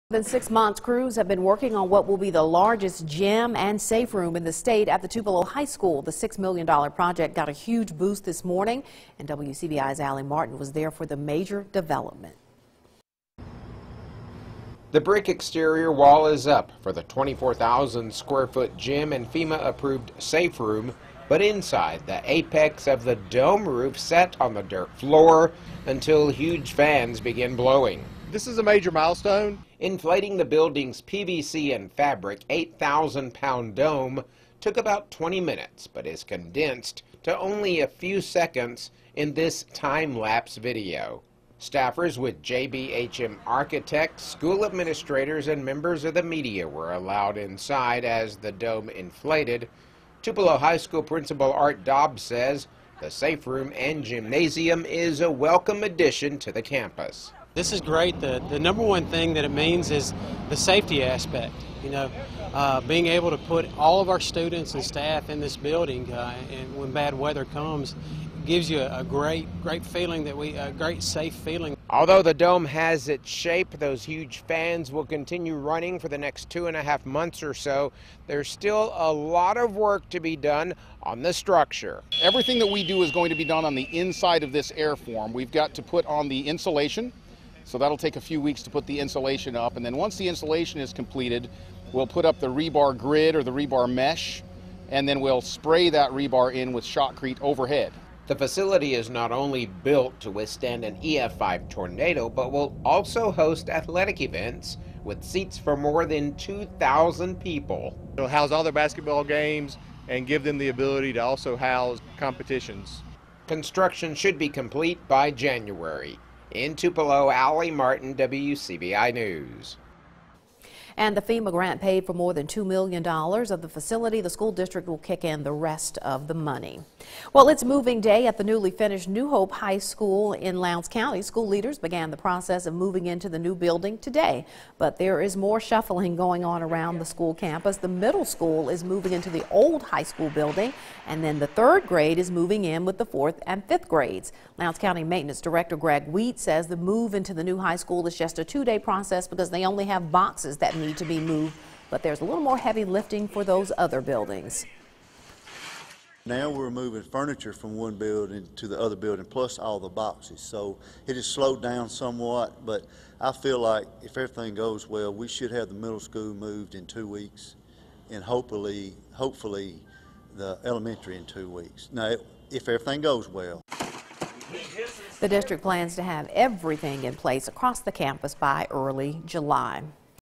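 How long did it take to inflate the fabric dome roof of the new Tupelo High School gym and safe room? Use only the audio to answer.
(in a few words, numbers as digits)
20 minutes.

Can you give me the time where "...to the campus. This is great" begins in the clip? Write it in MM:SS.
00:56.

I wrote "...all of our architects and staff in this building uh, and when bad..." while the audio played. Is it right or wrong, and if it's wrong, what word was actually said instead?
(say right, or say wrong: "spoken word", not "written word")
wrong: "students", not "architects".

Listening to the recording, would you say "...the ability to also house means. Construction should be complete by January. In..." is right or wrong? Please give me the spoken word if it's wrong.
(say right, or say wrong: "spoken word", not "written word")
wrong: "competitions", not "means".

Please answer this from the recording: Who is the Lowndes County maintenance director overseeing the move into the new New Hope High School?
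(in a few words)
Greg Wheat.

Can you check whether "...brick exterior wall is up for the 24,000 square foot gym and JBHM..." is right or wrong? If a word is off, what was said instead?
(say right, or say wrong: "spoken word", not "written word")
wrong: "FEMA", not "JBHM".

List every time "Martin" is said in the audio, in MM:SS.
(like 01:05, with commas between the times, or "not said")
00:10, 01:57.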